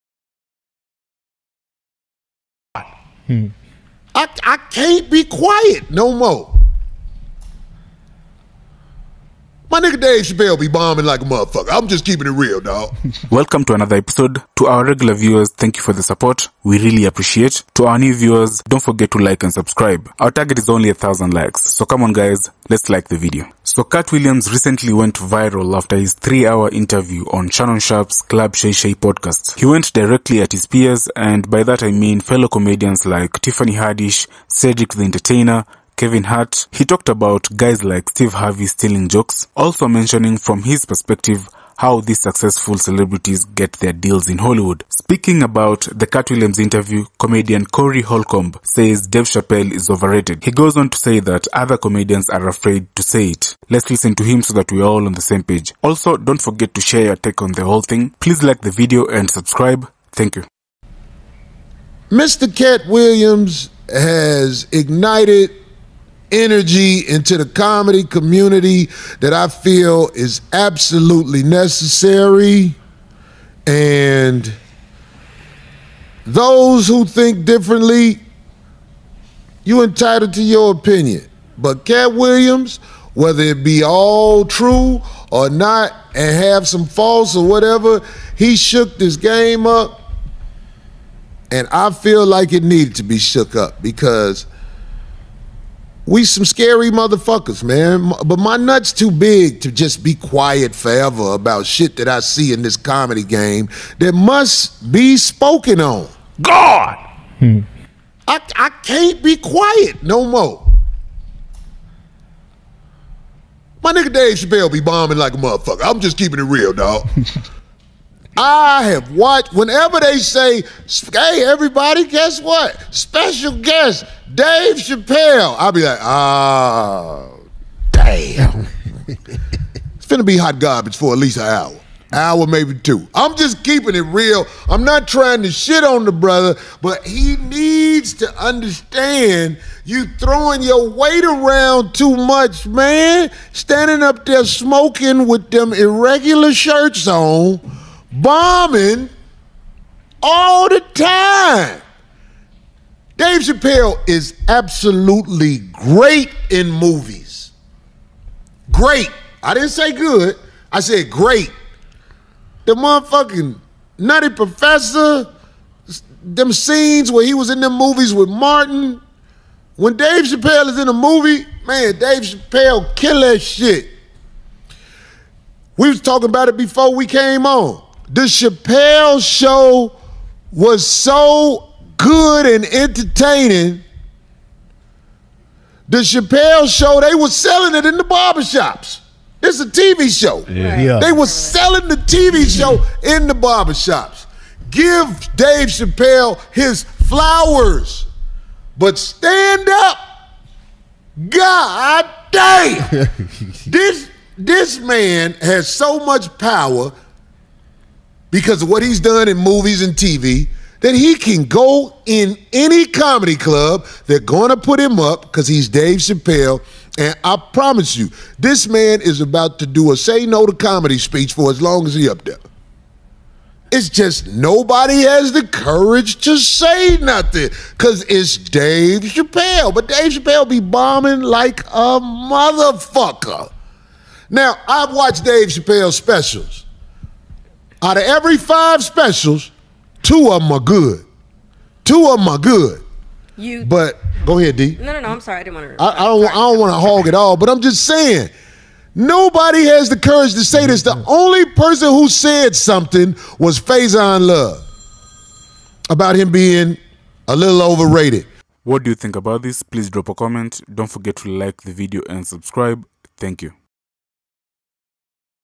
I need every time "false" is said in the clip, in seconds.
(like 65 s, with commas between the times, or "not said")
86 s.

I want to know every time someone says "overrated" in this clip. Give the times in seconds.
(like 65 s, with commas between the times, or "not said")
49 s, 257 s.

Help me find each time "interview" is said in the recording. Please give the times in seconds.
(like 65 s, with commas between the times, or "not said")
26 s, 46 s.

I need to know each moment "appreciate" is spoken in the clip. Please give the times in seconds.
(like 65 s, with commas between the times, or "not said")
17 s.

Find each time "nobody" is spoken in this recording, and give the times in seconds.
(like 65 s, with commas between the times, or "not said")
224 s, 248 s.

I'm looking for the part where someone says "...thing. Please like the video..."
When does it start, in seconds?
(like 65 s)
57 s.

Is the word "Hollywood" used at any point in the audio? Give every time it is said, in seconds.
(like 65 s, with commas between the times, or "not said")
44 s.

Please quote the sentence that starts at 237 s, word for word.
Out of every five specials, two of them are good.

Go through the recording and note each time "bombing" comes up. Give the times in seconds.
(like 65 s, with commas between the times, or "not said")
10 s, 114 s, 148 s, 230 s.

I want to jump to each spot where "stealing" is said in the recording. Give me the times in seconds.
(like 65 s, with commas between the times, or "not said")
38 s.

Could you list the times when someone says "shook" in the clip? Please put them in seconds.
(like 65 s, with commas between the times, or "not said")
88 s, 93 s.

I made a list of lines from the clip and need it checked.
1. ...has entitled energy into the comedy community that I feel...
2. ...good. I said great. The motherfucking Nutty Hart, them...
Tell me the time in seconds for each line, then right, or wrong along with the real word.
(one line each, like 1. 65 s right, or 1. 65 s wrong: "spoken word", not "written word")
1. 63 s wrong: "ignited", not "entitled"
2. 159 s wrong: "Professor", not "Hart".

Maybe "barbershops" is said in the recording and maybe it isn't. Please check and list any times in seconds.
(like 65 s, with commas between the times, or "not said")
188 s, 193 s.